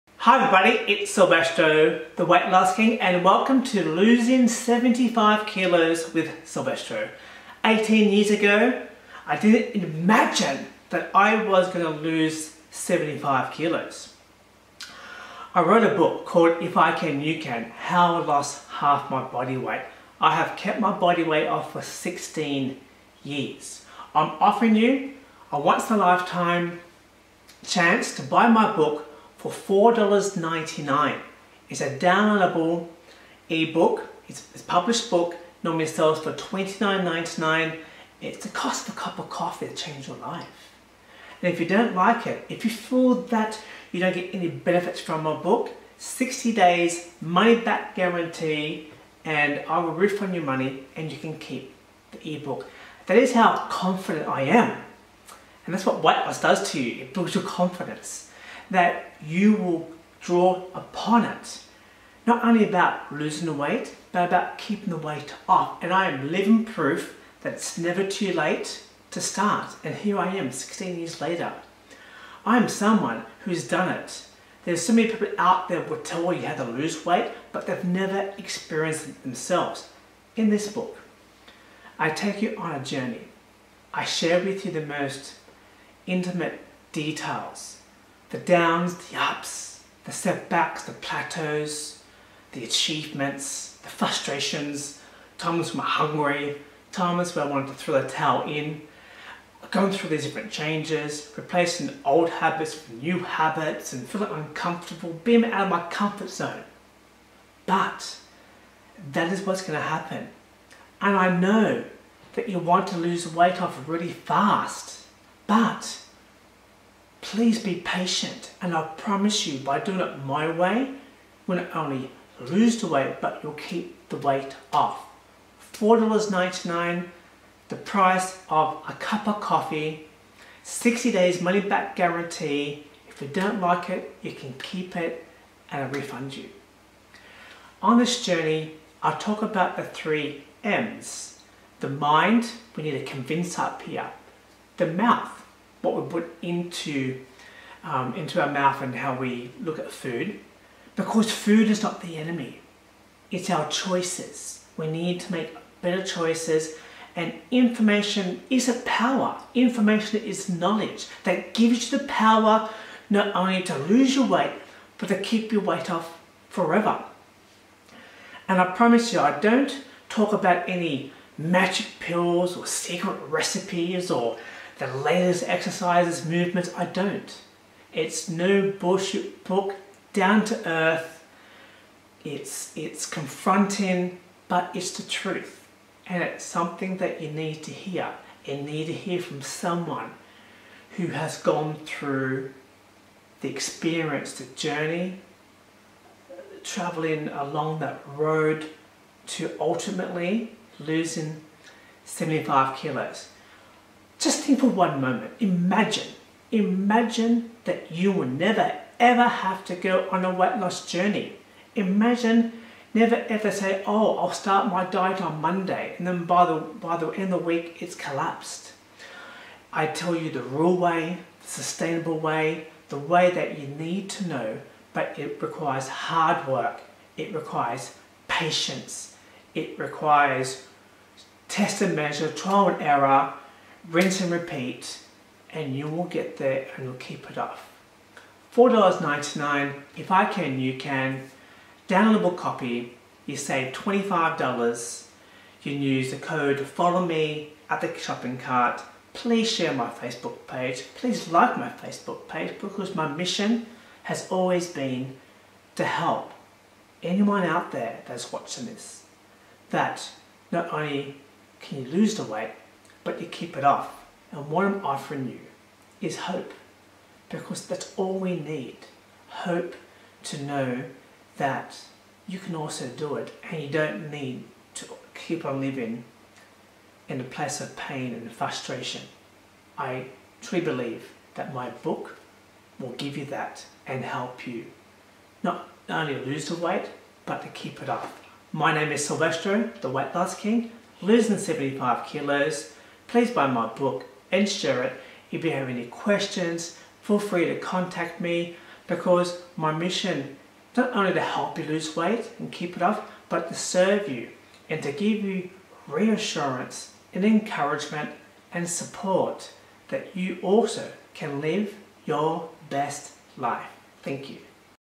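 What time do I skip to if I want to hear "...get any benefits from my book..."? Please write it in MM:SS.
00:44.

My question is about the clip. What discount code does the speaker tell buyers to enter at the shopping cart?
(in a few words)
follow me.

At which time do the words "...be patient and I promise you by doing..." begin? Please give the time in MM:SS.
01:57.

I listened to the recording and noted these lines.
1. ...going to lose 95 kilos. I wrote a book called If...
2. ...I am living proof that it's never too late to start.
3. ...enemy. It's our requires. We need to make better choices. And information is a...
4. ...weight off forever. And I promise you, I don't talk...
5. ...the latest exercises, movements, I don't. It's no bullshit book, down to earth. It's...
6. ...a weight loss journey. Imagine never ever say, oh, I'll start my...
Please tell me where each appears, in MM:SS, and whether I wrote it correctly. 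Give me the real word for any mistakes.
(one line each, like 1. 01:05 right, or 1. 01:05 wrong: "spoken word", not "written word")
1. 00:11 wrong: "75", not "95"
2. 01:05 right
3. 02:32 wrong: "choices", not "requires"
4. 02:45 right
5. 02:54 right
6. 03:30 right.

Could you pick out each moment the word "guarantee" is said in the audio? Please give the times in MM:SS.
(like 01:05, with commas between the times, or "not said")
00:47, 02:11.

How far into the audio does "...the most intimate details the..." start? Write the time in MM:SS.
01:24.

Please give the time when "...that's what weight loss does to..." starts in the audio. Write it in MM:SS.
00:55.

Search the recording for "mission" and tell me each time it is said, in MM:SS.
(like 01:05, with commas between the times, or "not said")
04:13, 04:59.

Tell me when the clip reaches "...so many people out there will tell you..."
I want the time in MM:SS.
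01:14.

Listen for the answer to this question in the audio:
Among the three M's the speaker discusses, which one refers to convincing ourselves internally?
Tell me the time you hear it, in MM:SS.
02:21.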